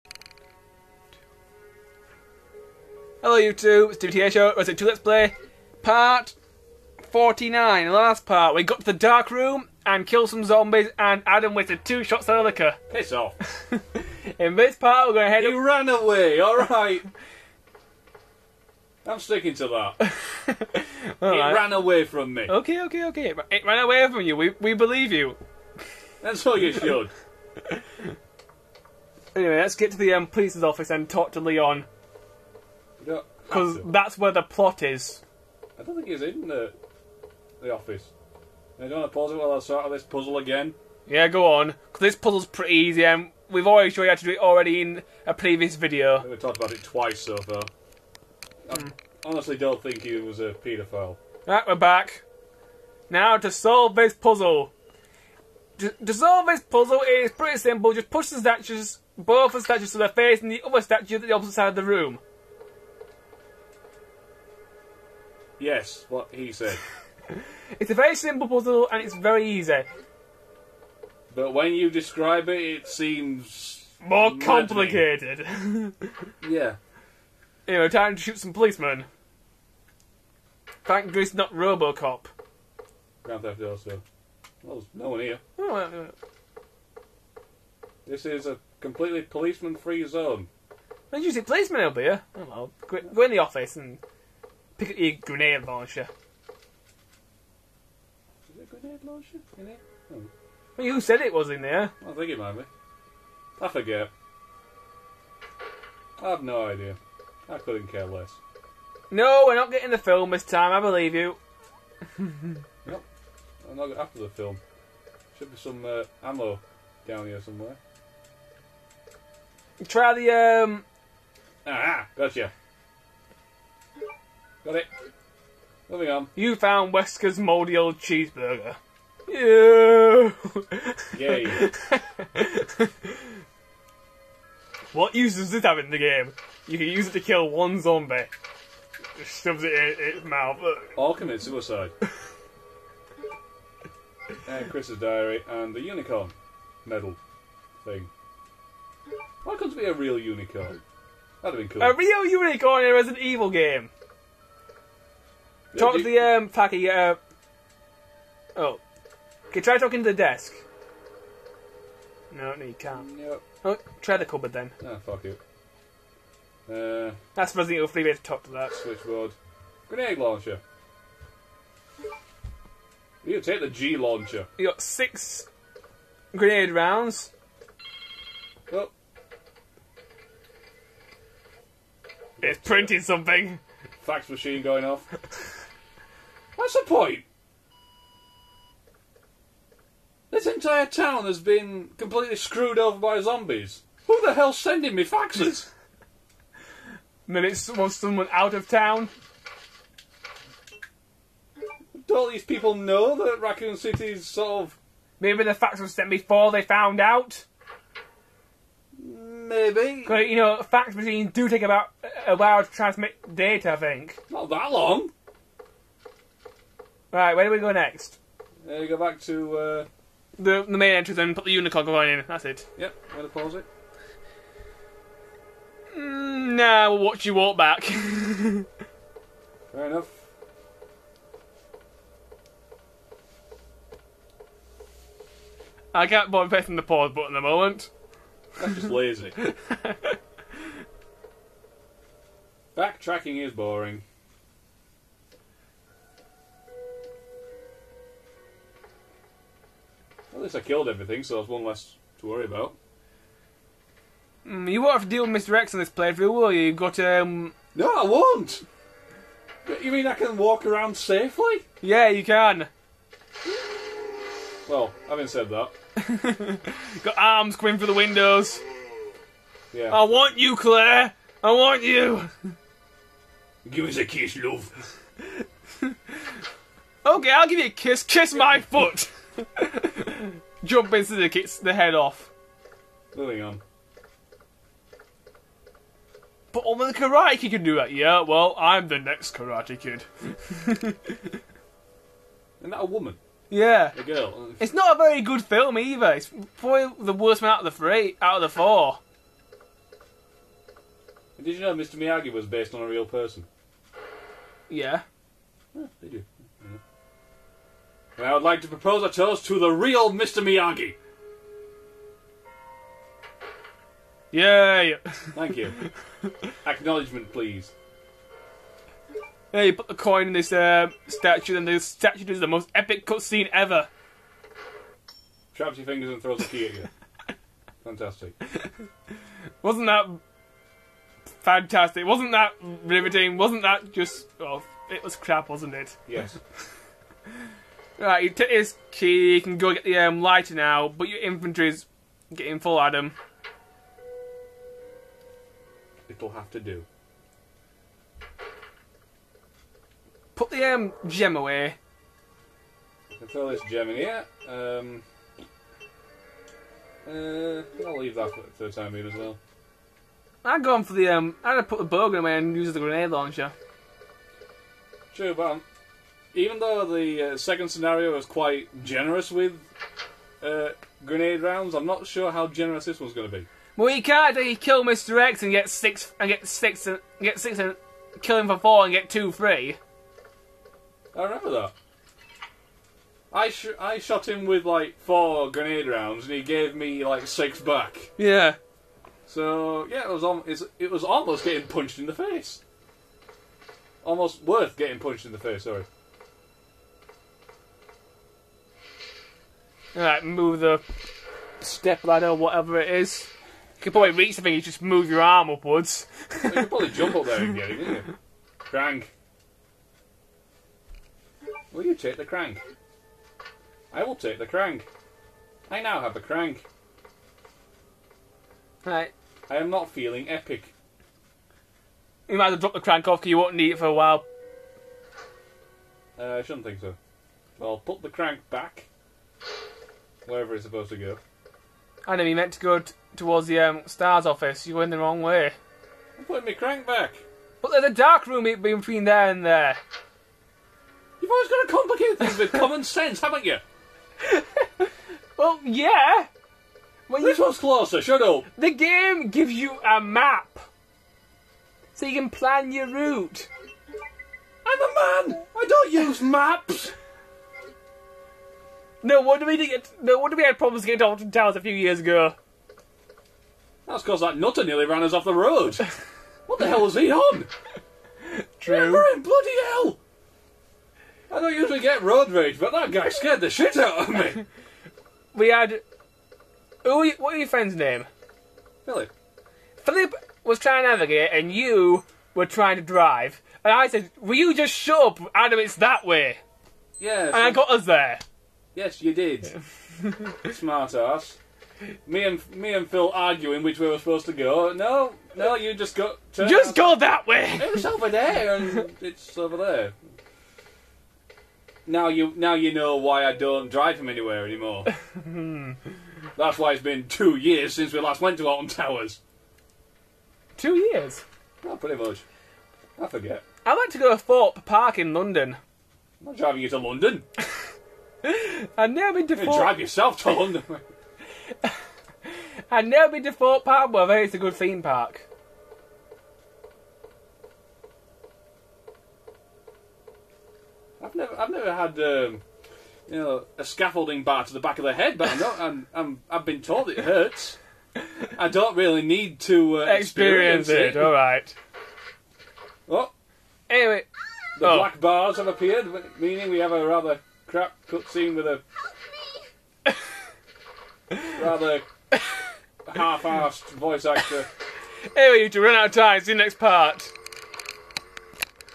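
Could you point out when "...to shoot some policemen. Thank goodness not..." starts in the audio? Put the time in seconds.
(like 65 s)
78 s.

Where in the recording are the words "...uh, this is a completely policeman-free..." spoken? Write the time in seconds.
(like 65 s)
85 s.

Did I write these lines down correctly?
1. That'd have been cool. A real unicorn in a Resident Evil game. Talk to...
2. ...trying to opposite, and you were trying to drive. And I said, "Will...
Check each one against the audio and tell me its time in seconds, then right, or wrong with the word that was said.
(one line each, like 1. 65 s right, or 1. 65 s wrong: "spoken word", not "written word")
1. 151 s right
2. 480 s wrong: "navigate", not "opposite".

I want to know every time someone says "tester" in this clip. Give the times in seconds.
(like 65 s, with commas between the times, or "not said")
not said.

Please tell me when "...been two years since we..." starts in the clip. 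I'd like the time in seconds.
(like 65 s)
506 s.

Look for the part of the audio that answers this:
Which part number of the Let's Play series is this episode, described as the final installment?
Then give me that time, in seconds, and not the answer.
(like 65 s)
5 s.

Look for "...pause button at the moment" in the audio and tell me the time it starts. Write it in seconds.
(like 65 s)
236 s.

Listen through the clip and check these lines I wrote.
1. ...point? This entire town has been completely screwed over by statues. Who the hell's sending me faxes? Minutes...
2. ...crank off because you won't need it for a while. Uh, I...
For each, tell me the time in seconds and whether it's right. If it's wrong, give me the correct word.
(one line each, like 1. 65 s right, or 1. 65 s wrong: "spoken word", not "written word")
1. 186 s wrong: "zombies", not "statues"
2. 422 s right.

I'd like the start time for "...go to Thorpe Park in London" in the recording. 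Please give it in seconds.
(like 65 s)
513 s.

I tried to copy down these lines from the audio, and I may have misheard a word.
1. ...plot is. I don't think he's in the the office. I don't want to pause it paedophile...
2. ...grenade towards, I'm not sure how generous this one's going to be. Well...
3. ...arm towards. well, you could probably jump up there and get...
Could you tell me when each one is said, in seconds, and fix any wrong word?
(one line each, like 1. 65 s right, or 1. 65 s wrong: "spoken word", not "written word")
1. 34 s wrong: "while", not "paedophile"
2. 371 s wrong: "rounds", not "towards"
3. 405 s wrong: "upwards", not "towards".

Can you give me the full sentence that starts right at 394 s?
Almost worth getting punched in the face.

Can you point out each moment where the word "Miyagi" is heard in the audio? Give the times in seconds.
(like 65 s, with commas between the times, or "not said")
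301 s, 310 s.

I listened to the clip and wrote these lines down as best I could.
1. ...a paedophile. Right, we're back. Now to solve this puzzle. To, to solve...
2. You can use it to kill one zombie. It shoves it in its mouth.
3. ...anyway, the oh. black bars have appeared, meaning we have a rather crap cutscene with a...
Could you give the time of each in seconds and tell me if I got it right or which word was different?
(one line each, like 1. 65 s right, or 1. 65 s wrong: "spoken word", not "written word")
1. 50 s right
2. 136 s right
3. 543 s right.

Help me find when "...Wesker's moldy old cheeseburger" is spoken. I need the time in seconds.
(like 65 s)
126 s.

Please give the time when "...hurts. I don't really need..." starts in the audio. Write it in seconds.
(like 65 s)
536 s.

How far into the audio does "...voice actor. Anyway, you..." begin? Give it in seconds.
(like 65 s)
553 s.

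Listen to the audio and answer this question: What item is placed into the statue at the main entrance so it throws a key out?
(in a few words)
unicorn coin.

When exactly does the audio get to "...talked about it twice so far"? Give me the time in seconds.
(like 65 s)
46 s.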